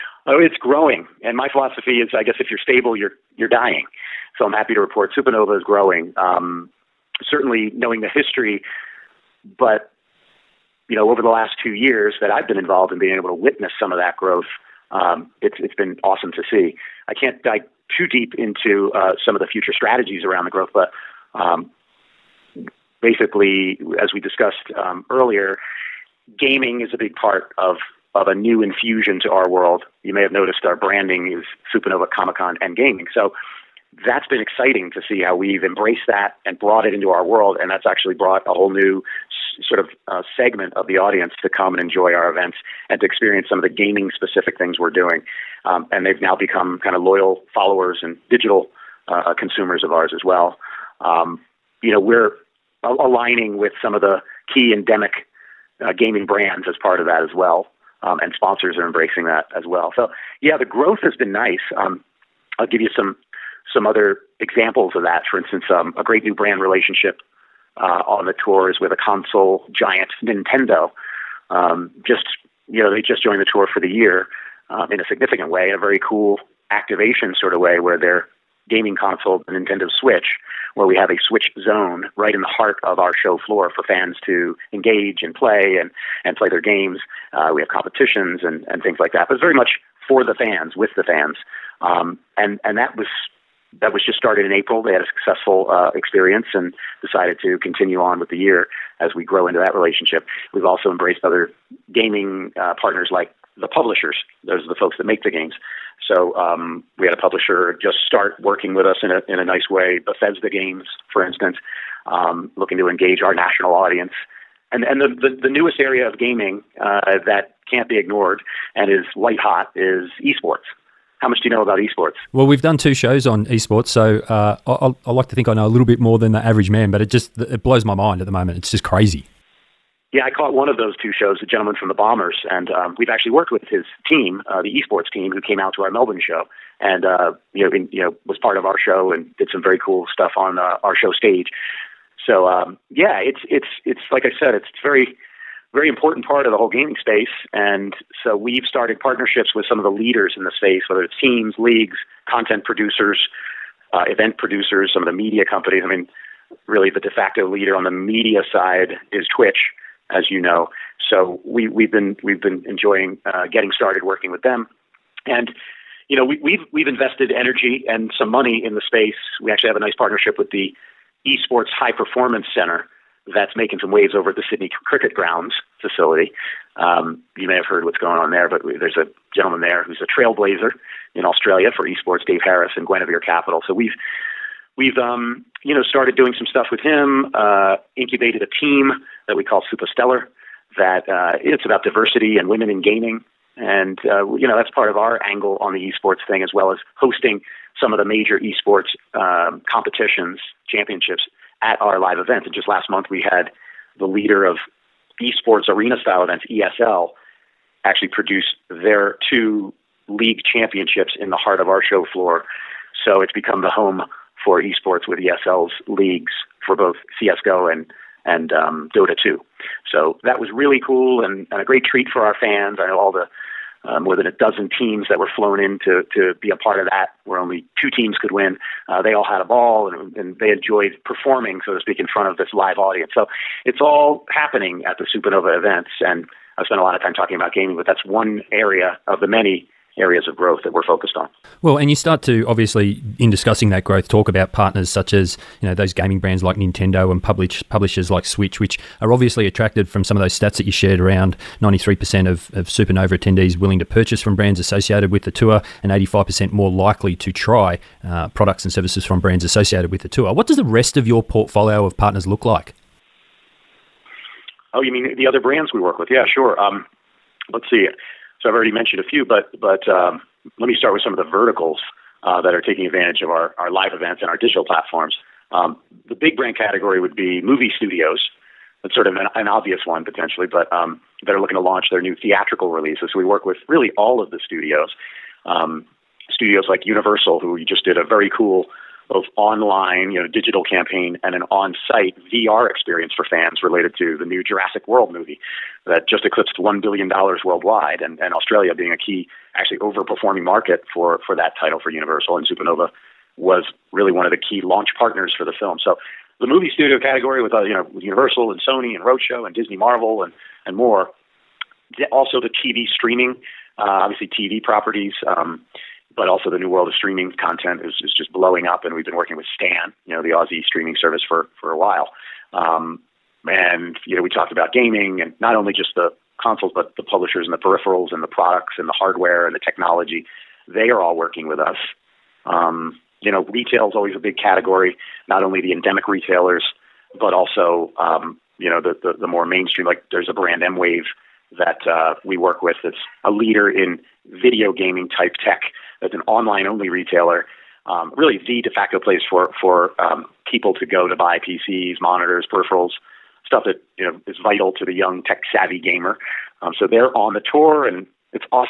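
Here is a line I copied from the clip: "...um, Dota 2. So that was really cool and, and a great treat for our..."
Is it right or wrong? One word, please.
right.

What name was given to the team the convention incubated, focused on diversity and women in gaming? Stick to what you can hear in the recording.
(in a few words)
Supastellar.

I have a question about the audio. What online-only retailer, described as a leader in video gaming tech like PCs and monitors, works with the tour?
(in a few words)
MWave.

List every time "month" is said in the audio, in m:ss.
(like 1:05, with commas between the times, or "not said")
3:22.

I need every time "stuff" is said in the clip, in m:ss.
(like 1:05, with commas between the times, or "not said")
2:20, 3:06, 5:53.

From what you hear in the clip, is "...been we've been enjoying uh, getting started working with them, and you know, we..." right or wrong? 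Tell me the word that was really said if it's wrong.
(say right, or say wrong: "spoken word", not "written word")
right.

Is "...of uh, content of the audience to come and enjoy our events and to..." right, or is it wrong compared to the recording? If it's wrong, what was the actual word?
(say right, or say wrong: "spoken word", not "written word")
wrong: "segment", not "content".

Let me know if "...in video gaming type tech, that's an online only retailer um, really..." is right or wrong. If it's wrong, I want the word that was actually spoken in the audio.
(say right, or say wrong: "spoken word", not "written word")
right.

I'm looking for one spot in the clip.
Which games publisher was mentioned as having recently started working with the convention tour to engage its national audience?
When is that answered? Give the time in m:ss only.
1:49.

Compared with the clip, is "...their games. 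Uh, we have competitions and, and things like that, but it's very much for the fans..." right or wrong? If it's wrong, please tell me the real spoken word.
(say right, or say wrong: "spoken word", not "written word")
right.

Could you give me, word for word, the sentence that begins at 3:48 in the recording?
Uh, they all had a ball and, and they enjoyed performing, so to speak, in front of this live audience.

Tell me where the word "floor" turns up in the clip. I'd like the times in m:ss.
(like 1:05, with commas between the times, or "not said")
1:23, 3:32.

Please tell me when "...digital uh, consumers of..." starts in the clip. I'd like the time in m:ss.
0:48.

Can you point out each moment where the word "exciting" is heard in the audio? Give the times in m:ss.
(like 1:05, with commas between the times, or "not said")
0:34.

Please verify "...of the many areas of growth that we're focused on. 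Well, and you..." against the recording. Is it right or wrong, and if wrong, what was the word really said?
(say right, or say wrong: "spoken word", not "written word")
right.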